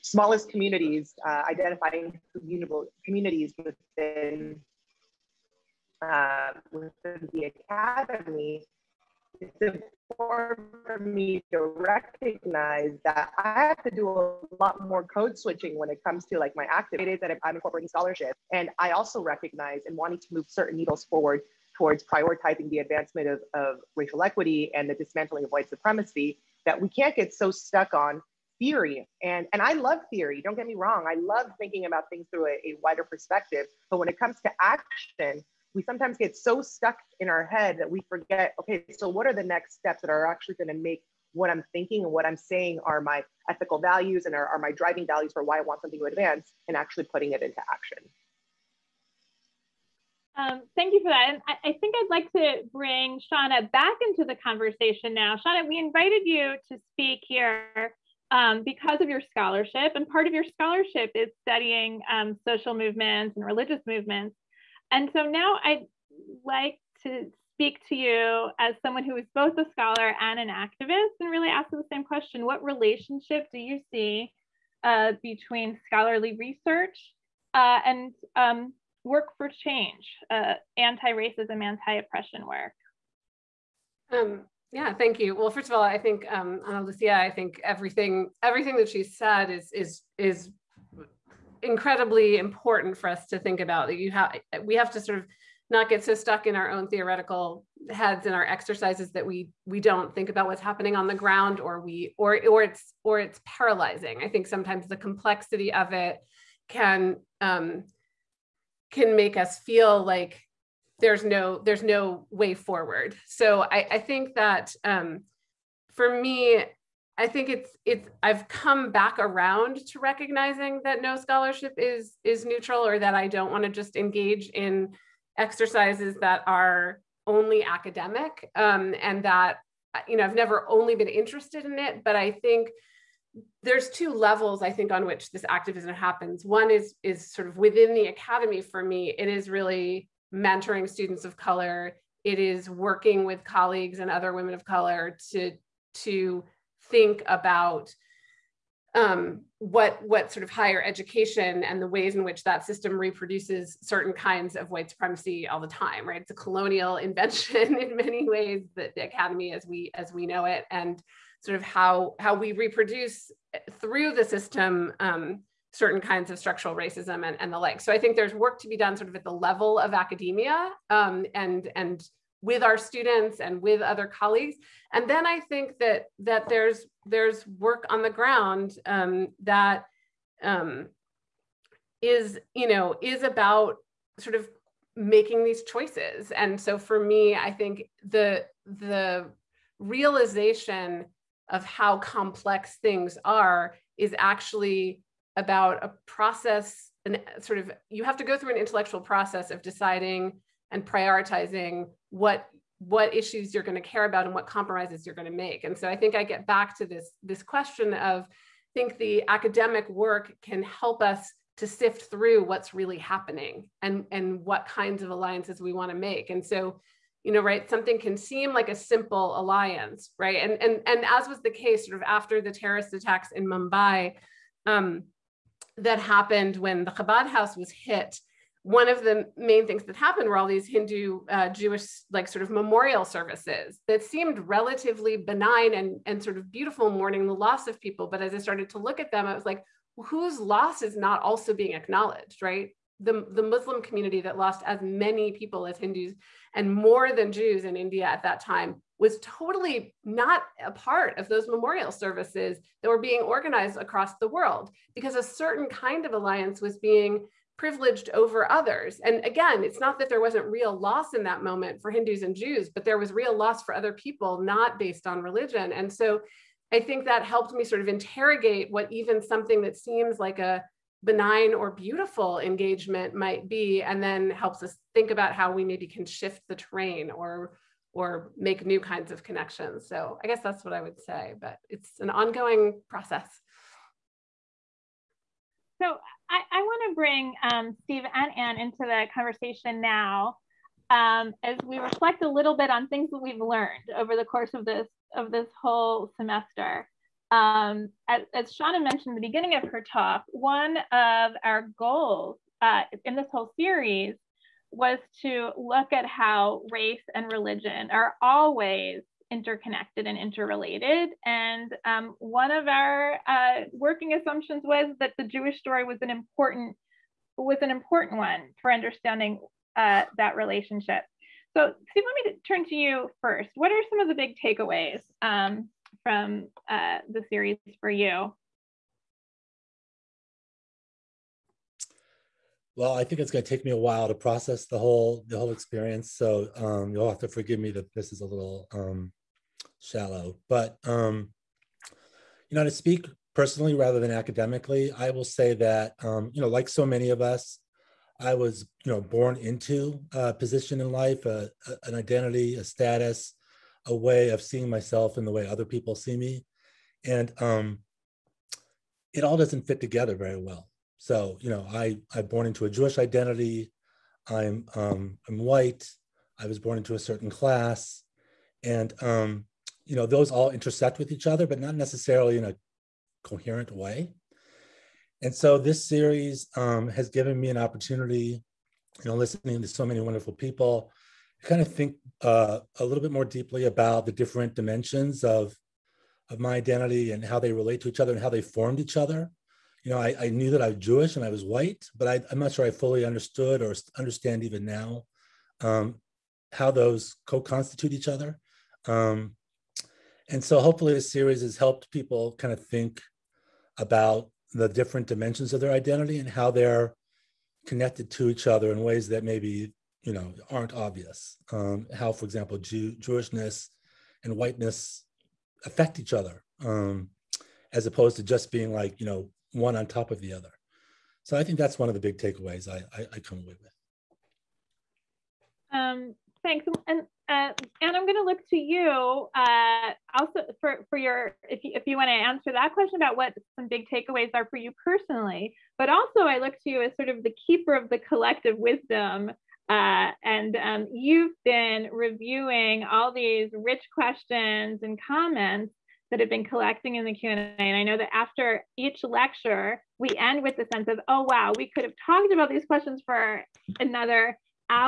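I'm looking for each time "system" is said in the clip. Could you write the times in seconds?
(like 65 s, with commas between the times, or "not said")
152 s, 164 s.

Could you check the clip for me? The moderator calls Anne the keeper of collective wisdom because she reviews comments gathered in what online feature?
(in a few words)
Q&A.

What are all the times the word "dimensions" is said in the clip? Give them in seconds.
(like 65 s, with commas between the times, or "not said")
384 s, 405 s.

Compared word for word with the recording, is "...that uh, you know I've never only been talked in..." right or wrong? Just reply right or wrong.
wrong.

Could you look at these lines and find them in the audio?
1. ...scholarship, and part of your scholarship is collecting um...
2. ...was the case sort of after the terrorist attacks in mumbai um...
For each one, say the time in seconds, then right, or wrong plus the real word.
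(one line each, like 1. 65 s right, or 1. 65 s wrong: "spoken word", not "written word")
1. 59 s wrong: "studying", not "collecting"
2. 221 s right.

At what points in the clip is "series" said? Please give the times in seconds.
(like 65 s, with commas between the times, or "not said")
303 s, 327 s, 375 s, 401 s.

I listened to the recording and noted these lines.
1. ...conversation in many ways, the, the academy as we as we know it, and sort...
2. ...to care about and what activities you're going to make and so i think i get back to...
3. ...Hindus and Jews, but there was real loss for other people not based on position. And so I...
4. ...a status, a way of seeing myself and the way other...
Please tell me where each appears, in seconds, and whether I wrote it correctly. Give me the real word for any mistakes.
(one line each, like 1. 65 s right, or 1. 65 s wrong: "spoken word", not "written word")
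1. 156 s wrong: "invention", not "conversation"
2. 203 s wrong: "compromises", not "activities"
3. 261 s wrong: "religion", not "position"
4. 352 s right.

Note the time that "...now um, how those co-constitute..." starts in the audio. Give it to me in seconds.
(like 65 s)
394 s.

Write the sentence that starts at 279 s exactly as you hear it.
So I guess that's what I would say, but it's an ongoing process.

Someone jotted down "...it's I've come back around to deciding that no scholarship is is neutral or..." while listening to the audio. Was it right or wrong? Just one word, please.
wrong.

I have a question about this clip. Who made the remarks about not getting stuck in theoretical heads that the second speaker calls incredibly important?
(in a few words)
Analucía.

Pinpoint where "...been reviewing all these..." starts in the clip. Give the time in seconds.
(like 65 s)
441 s.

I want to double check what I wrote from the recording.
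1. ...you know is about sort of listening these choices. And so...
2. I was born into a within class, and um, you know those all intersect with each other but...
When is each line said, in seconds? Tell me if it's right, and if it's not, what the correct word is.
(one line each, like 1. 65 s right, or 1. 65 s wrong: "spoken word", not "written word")
1. 182 s wrong: "making", not "listening"
2. 366 s wrong: "certain", not "within".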